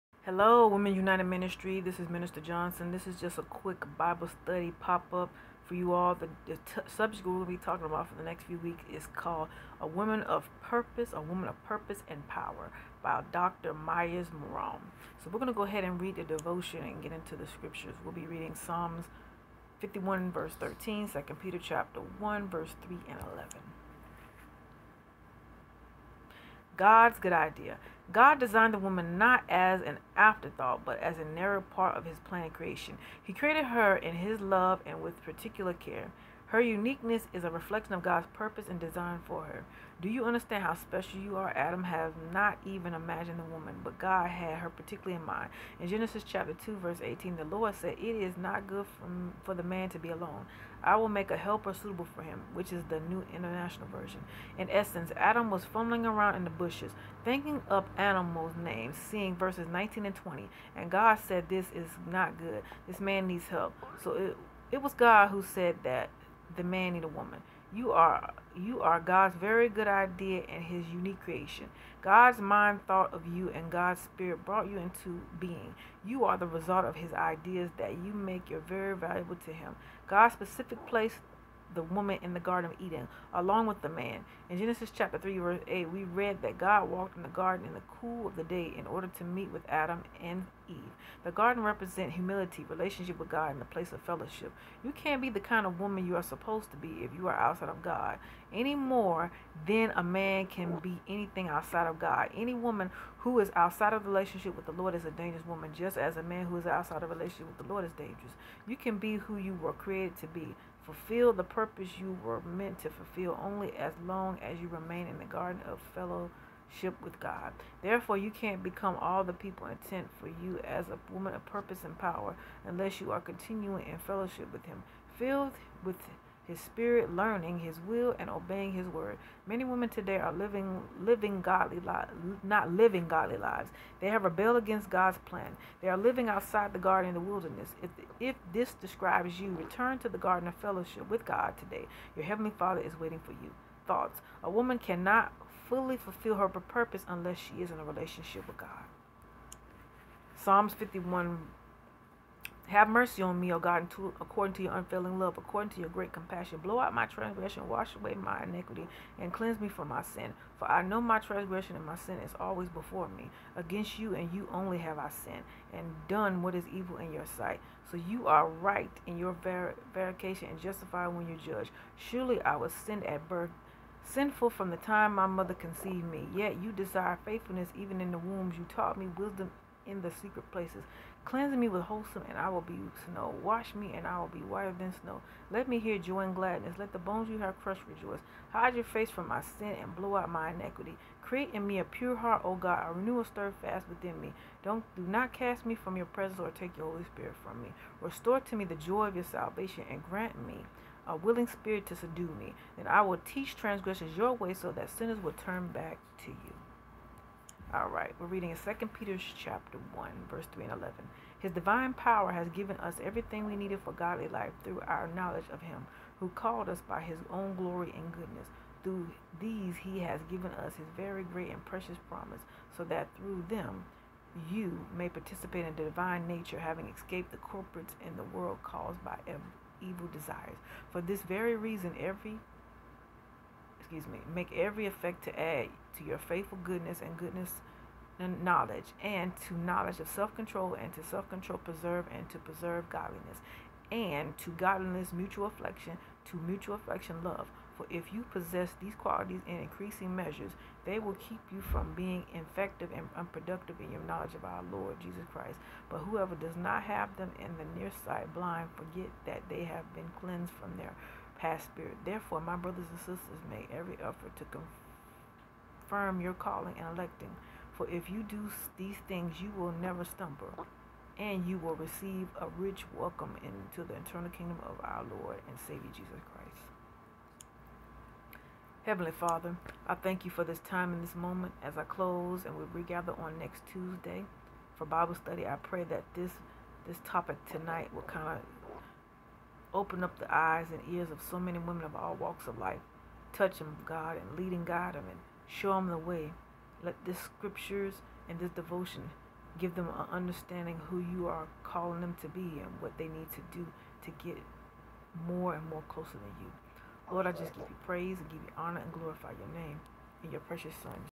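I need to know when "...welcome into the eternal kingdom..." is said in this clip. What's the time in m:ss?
4:32.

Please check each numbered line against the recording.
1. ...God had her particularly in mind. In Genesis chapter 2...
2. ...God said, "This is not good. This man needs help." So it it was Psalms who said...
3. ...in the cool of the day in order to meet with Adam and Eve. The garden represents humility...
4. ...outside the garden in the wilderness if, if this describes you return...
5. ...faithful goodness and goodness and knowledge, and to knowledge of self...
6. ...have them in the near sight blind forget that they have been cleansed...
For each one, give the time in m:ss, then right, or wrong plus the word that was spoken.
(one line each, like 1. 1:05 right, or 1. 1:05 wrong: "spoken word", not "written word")
1. 0:43 right
2. 1:00 wrong: "God", not "Psalms"
3. 1:27 right
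4. 2:16 right
5. 3:56 right
6. 4:16 right.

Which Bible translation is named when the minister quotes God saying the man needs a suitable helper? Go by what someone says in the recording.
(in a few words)
New International Version.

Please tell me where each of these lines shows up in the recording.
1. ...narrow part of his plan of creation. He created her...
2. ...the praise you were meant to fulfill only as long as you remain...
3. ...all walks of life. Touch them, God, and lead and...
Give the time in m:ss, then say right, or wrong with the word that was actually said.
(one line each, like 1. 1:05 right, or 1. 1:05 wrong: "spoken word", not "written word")
1. 0:31 right
2. 1:51 wrong: "purpose", not "praise"
3. 4:51 right.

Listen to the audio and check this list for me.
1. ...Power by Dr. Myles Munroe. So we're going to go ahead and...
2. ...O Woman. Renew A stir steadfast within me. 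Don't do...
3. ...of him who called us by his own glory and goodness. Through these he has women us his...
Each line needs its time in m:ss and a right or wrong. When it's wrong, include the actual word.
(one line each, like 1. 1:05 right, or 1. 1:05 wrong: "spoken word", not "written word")
1. 0:12 right
2. 3:12 wrong: "God", not "Woman"
3. 3:35 wrong: "given", not "women".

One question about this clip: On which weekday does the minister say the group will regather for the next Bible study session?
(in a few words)
Tuesday.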